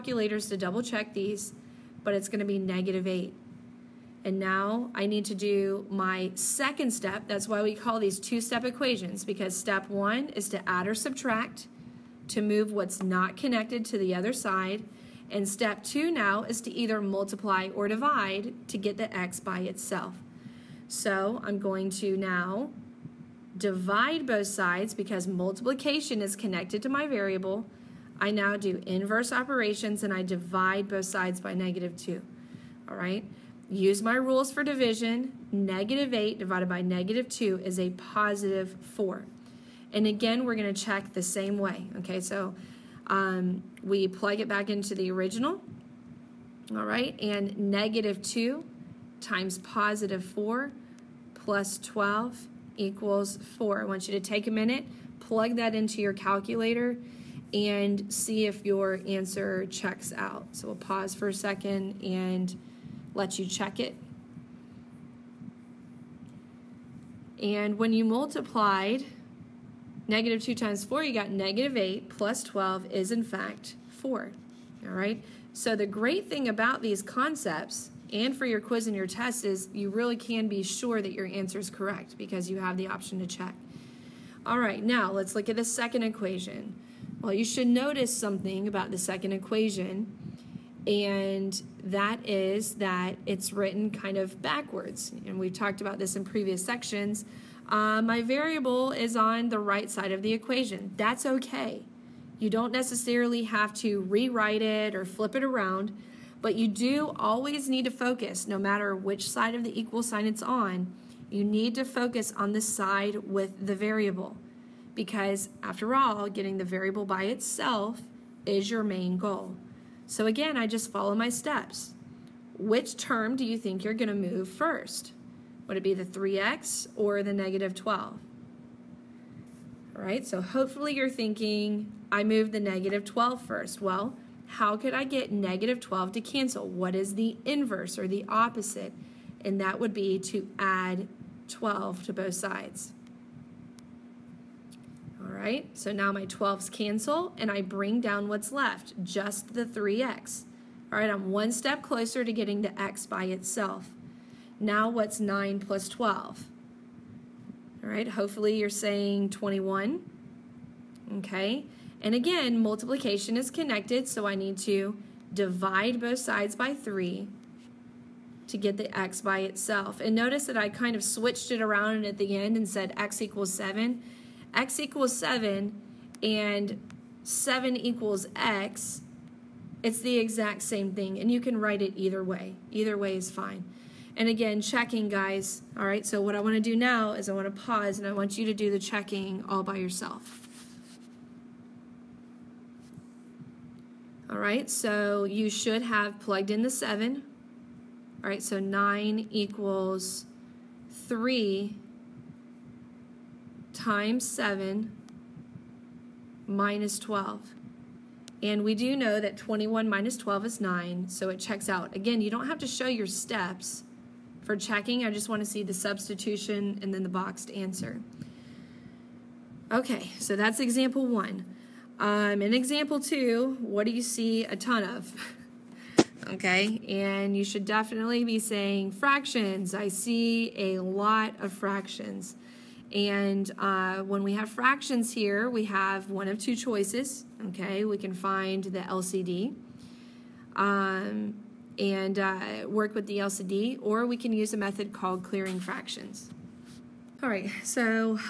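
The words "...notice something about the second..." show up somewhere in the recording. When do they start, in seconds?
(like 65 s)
87 s.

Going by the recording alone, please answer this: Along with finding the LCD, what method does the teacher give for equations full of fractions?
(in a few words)
clearing fractions.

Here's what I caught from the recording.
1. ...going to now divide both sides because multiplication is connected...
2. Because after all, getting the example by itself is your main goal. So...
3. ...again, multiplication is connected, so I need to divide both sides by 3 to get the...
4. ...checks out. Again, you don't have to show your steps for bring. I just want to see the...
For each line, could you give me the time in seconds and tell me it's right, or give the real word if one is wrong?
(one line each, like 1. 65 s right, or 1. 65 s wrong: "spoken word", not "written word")
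1. 21 s right
2. 114 s wrong: "variable", not "example"
3. 162 s right
4. 211 s wrong: "checking", not "bring".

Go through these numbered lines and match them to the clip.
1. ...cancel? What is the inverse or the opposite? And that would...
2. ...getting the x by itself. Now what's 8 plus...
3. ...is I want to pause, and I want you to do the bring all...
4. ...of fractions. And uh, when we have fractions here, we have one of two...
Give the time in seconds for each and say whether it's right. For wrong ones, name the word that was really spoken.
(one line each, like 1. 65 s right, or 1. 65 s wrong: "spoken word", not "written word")
1. 136 s right
2. 152 s wrong: "9", not "8"
3. 187 s wrong: "checking", not "bring"
4. 231 s right.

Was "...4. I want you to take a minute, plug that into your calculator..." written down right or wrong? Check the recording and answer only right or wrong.
right.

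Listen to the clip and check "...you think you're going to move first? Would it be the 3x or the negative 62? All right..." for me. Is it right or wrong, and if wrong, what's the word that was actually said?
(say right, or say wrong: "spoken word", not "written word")
wrong: "12", not "62".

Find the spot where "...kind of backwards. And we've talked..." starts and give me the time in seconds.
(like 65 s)
93 s.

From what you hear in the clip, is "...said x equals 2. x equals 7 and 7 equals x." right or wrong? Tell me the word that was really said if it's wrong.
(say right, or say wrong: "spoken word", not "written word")
wrong: "7", not "2".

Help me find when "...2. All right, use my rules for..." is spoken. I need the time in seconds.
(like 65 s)
31 s.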